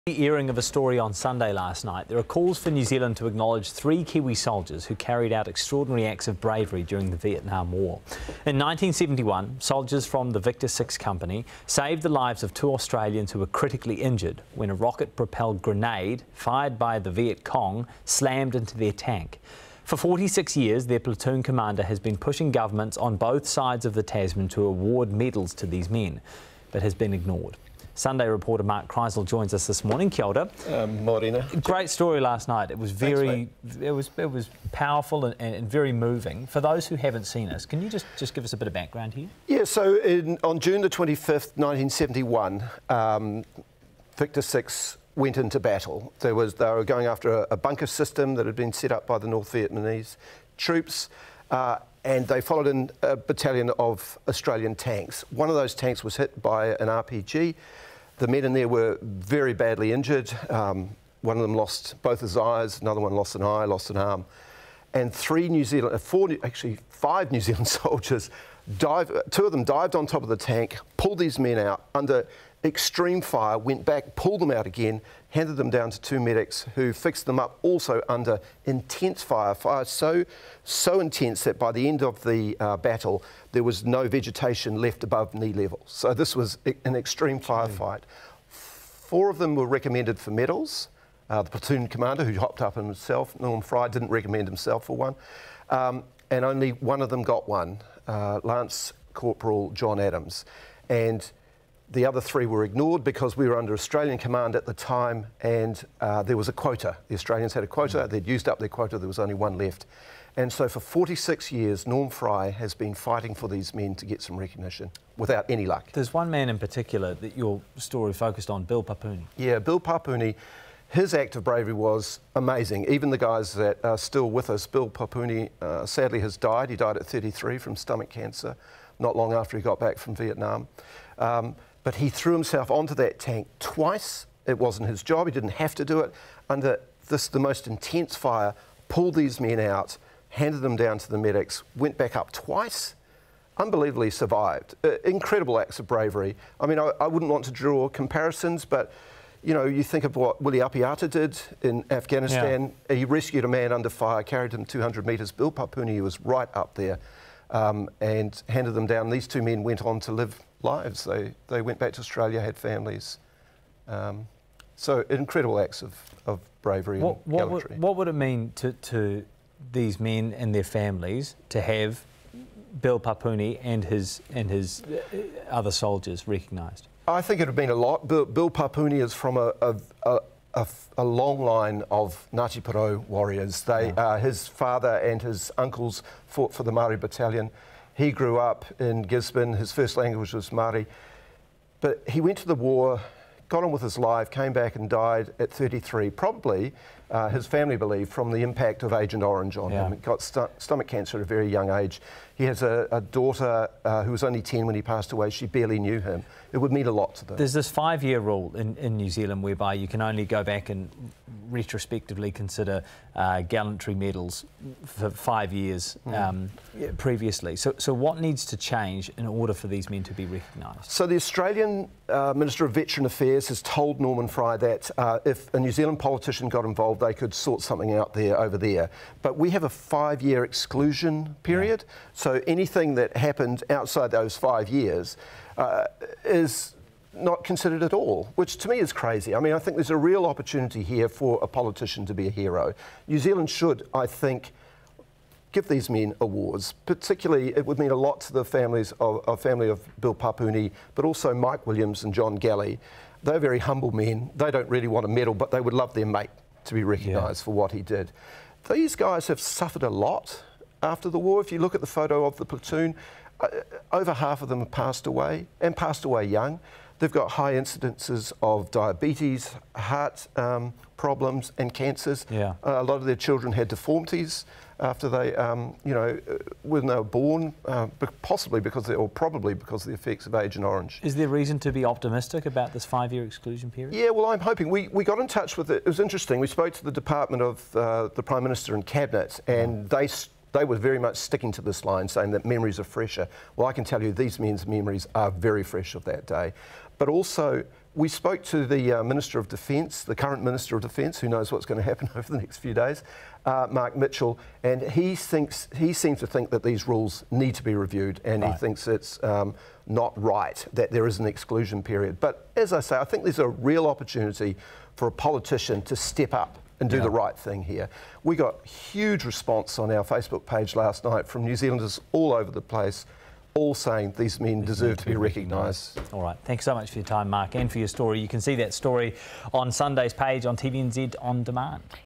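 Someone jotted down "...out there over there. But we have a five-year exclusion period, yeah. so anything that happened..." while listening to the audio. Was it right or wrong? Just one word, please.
right.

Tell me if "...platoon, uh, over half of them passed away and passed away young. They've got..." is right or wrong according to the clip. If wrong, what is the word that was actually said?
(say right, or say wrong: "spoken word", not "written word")
right.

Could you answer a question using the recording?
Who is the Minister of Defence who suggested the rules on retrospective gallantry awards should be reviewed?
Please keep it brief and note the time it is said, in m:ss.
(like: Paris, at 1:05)
Mark Mitchell, at 5:03.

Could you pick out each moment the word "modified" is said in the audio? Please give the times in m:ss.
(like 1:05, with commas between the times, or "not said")
not said.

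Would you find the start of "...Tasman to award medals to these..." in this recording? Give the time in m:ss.
0:24.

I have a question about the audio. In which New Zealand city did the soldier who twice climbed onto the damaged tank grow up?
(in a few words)
Gisborne.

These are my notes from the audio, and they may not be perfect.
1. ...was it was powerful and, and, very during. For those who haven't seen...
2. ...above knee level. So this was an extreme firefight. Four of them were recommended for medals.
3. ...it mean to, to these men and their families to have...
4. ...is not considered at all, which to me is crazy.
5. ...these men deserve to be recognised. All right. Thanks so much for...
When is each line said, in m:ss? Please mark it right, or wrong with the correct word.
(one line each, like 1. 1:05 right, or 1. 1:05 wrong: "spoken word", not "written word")
1. 0:33 wrong: "moving", not "during"
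2. 1:25 right
3. 2:48 right
4. 3:56 right
5. 5:24 right.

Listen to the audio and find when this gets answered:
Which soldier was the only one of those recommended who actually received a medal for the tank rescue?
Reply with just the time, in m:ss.
1:38.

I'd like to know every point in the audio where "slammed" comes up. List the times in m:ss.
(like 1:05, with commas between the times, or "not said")
0:18.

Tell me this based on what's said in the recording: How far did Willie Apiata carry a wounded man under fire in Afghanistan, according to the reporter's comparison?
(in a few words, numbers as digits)
200 metres.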